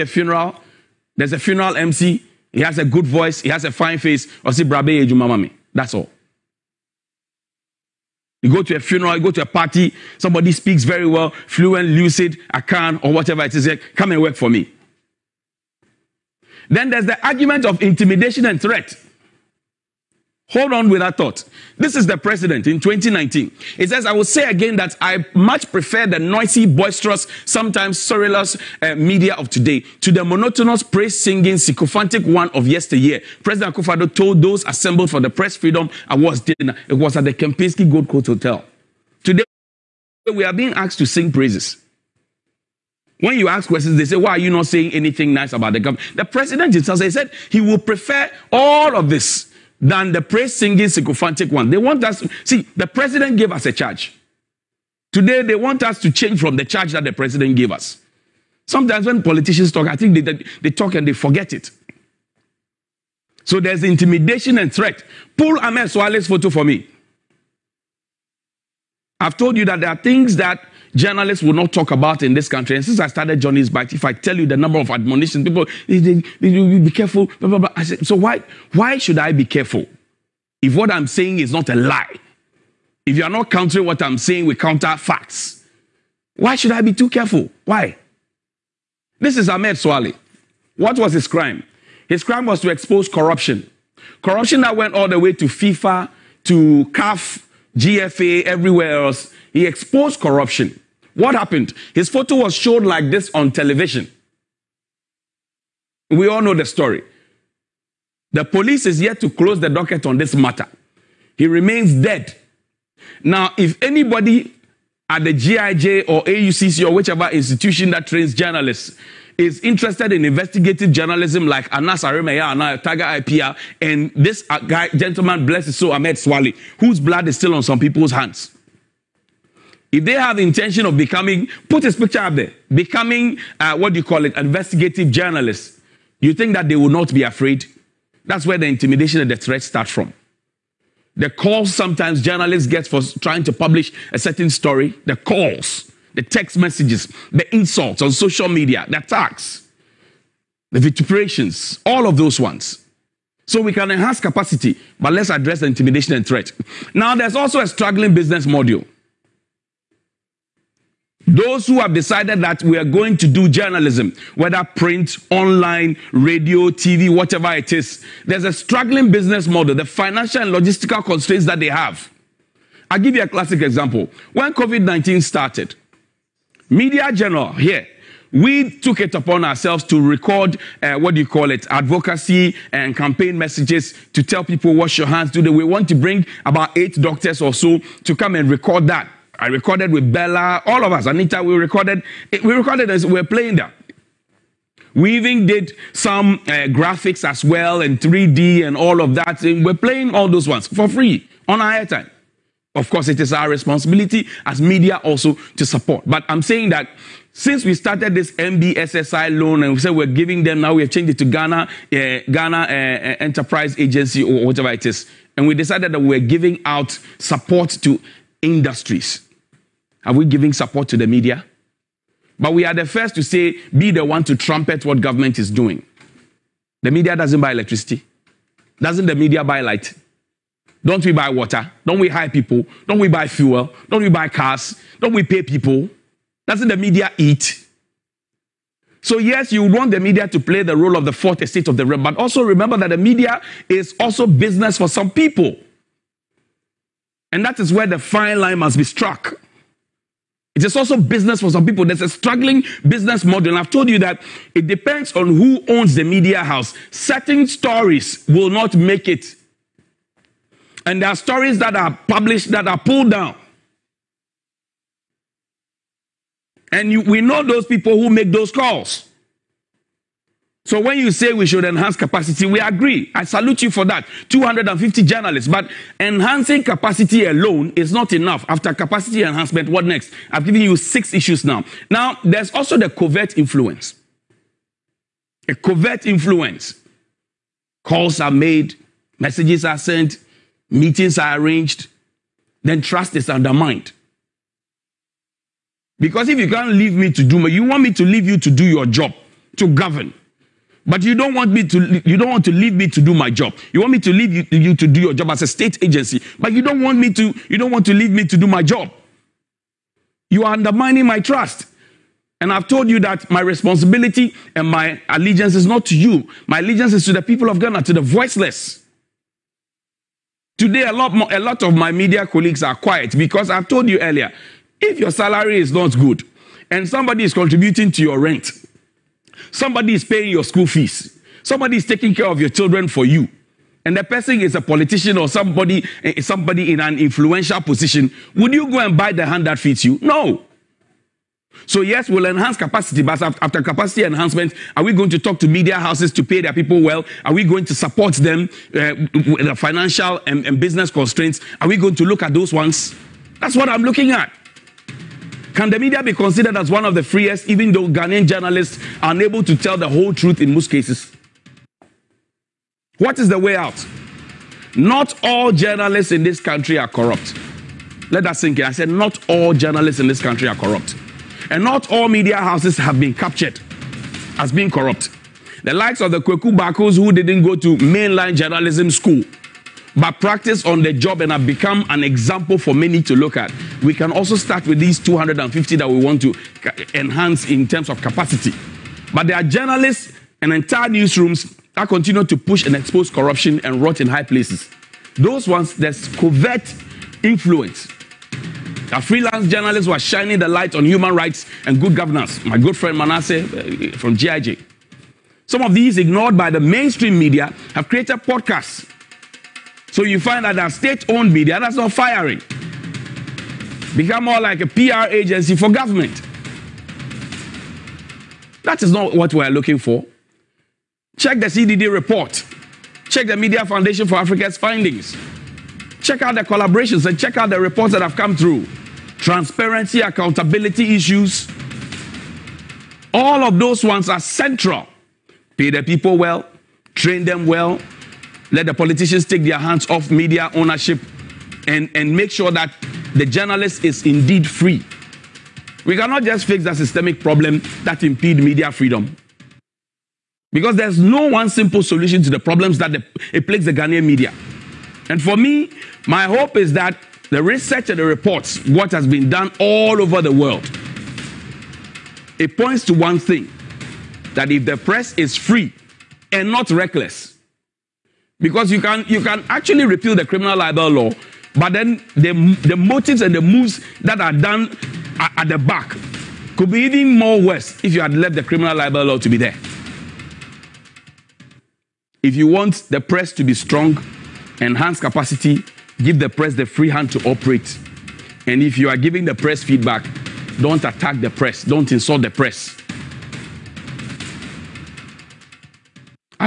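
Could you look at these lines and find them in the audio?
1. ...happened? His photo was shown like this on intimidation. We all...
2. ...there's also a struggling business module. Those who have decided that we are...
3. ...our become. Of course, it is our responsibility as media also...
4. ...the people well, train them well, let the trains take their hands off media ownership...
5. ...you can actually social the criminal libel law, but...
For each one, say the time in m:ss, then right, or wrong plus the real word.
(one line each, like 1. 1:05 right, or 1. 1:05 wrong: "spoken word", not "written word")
1. 1:41 wrong: "television", not "intimidation"
2. 2:37 right
3. 3:21 wrong: "airtime", not "become"
4. 7:15 wrong: "politicians", not "trains"
5. 7:49 wrong: "repeal", not "social".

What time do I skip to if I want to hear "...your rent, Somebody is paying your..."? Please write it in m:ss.
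5:28.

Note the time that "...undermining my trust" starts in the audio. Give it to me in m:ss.
5:10.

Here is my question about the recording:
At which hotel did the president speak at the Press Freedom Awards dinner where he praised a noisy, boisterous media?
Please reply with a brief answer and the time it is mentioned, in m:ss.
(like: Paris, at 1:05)
Kempinski Gold Coast Hotel, at 0:37.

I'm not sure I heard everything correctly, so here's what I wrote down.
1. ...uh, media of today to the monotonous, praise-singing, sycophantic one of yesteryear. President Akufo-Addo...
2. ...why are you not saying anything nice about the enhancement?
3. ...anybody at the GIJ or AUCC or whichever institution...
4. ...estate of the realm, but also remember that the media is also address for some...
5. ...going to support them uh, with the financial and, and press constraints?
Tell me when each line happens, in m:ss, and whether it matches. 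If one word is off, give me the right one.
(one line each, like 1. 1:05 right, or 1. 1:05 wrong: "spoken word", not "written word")
1. 0:28 right
2. 0:44 wrong: "government", not "enhancement"
3. 1:53 right
4. 4:01 wrong: "business", not "address"
5. 5:47 wrong: "business", not "press".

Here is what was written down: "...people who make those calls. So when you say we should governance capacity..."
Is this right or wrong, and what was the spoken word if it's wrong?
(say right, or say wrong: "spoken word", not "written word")
wrong: "enhance", not "governance".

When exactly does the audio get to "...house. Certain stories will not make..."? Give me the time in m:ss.
4:16.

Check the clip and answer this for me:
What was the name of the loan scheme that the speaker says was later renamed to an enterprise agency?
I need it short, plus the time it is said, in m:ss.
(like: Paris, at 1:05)
NBSSI, at 3:28.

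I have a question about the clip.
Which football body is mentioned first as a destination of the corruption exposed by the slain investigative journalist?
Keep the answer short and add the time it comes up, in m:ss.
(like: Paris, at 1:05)
FIFA, at 1:35.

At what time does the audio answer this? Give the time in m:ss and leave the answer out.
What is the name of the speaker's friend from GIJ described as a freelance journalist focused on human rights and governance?
6:42.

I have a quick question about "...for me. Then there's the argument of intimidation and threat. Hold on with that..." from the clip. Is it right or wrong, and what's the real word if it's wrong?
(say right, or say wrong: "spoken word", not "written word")
right.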